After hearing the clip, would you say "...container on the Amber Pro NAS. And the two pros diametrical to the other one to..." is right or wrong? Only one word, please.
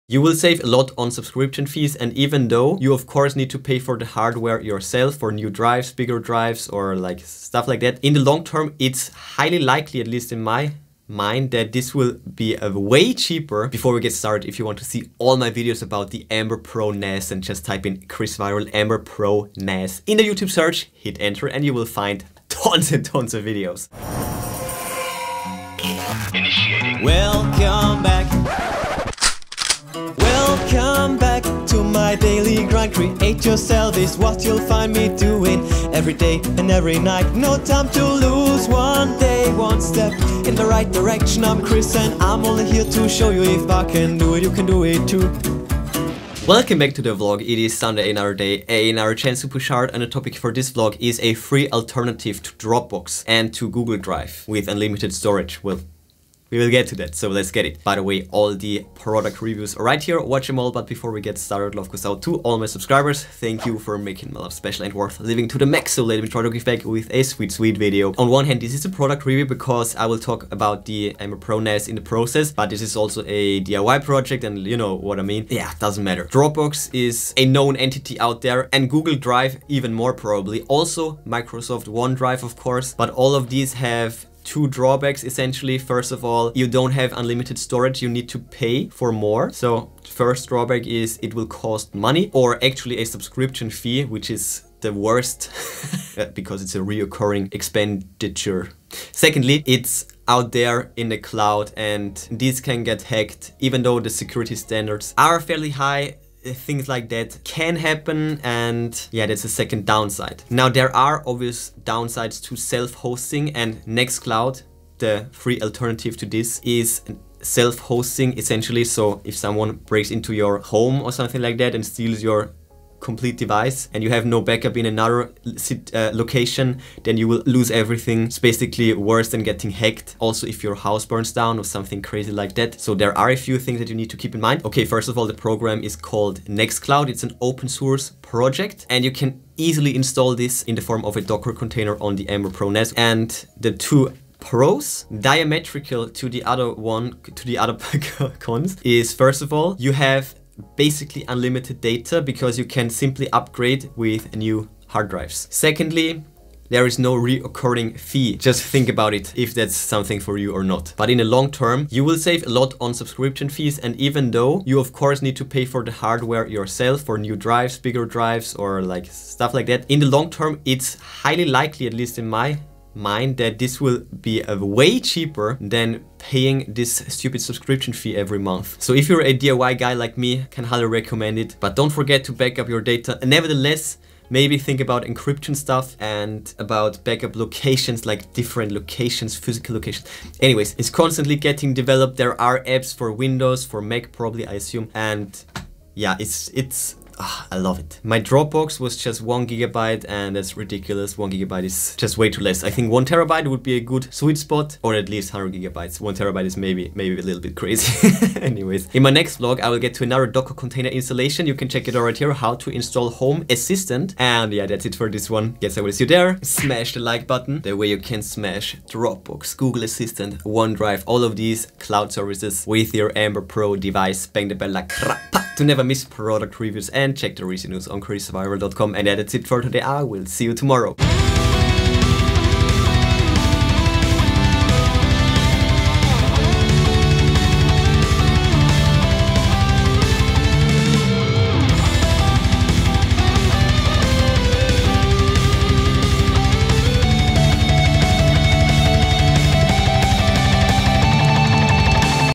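right.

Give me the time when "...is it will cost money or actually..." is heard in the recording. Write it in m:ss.
1:30.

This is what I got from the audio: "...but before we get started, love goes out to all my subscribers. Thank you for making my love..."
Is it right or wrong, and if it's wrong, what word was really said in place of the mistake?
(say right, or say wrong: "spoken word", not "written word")
right.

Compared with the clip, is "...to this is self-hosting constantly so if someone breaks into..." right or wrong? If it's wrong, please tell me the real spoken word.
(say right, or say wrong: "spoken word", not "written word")
wrong: "essentially", not "constantly".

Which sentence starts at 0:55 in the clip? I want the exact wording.
Well, we will get to that, so let's get it.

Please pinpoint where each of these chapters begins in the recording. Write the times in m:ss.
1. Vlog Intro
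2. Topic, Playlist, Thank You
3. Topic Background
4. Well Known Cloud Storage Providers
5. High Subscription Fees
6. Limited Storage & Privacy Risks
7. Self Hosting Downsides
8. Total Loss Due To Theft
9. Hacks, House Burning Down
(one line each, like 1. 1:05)
1. 0:23
2. 0:46
3. 1:07
4. 1:17
5. 1:27
6. 1:37
7. 1:47
8. 1:57
9. 2:07.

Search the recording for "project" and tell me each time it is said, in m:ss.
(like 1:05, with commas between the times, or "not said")
1:14, 2:18.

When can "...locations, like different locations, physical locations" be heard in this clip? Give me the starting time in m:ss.
3:07.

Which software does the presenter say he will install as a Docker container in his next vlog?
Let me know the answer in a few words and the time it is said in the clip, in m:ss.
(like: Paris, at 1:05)
Home Assistant, at 3:33.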